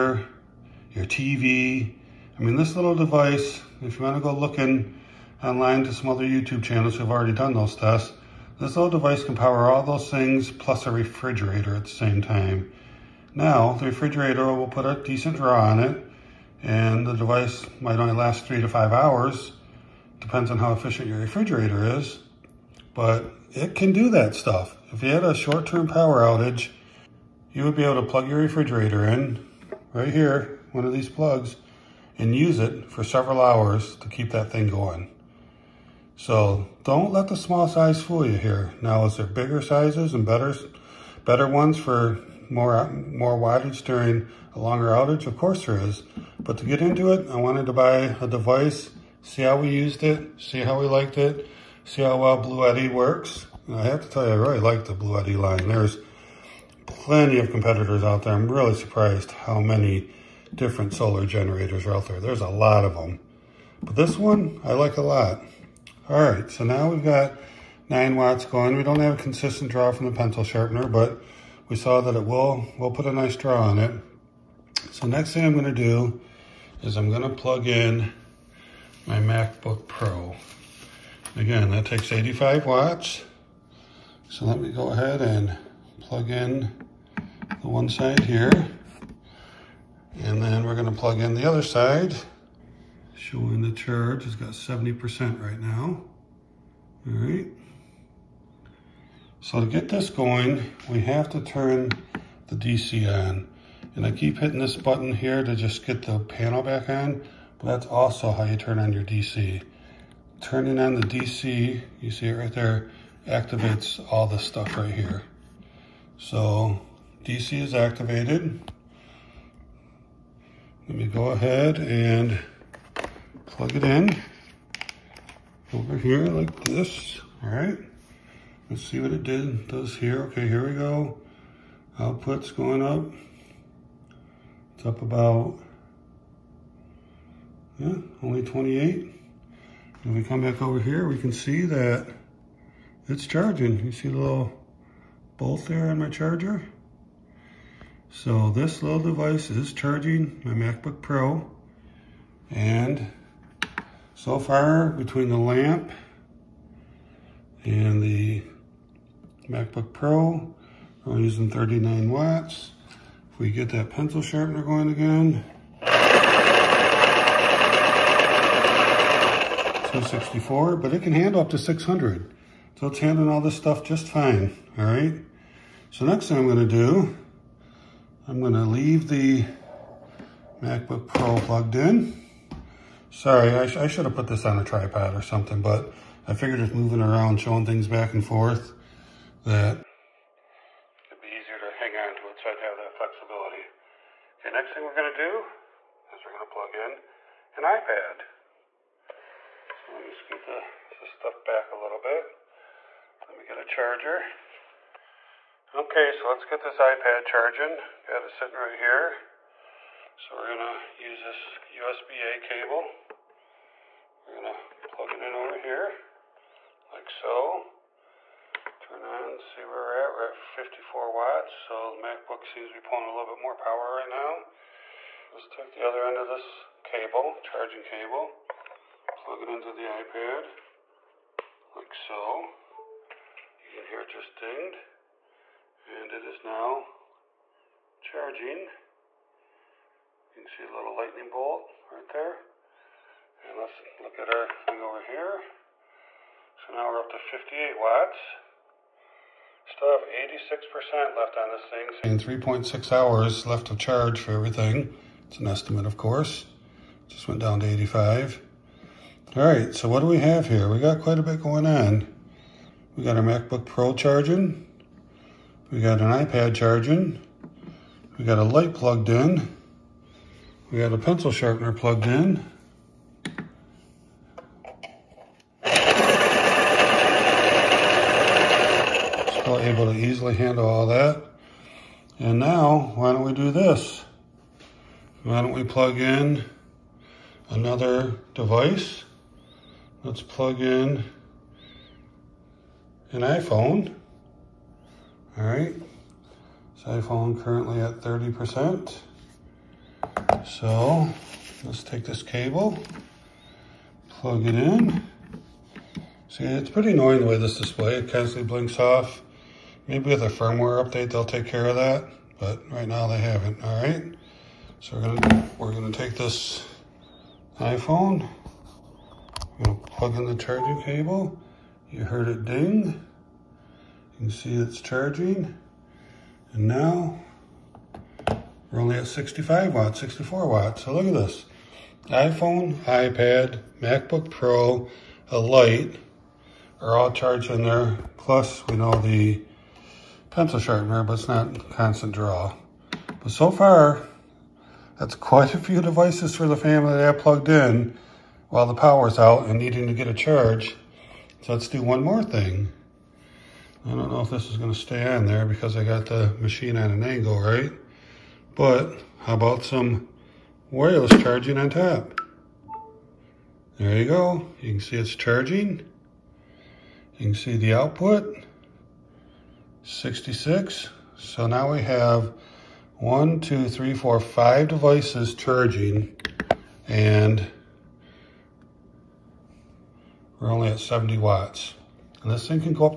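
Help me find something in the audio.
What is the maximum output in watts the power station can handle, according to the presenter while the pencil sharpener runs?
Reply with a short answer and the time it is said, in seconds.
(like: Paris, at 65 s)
600, at 171 s.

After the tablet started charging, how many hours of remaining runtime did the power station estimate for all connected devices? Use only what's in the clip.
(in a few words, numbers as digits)
3.6 hours.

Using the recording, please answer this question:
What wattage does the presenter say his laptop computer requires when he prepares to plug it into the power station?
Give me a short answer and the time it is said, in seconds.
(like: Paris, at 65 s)
85 watts, at 82 s.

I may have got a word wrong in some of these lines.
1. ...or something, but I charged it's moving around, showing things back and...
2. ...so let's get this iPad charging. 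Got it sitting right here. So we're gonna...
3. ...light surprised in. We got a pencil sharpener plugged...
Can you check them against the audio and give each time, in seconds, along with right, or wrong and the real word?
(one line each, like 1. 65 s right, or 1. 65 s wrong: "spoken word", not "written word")
1. 185 s wrong: "figured", not "charged"
2. 206 s right
3. 268 s wrong: "plugged", not "surprised".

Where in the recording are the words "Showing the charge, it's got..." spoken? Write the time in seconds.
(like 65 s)
93 s.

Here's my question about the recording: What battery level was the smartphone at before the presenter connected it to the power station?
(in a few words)
30%.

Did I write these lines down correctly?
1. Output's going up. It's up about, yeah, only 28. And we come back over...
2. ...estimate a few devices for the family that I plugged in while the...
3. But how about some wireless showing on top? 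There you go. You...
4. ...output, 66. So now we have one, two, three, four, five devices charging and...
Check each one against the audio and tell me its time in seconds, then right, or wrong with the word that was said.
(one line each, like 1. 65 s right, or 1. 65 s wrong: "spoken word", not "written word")
1. 131 s right
2. 345 s wrong: "quite", not "estimate"
3. 358 s wrong: "charging", not "showing"
4. 367 s right.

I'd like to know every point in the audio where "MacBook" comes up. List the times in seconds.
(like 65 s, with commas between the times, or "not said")
79 s, 150 s, 159 s, 180 s, 221 s, 263 s, 333 s.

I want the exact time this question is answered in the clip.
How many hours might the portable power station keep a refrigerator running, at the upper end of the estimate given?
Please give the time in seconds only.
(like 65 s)
18 s.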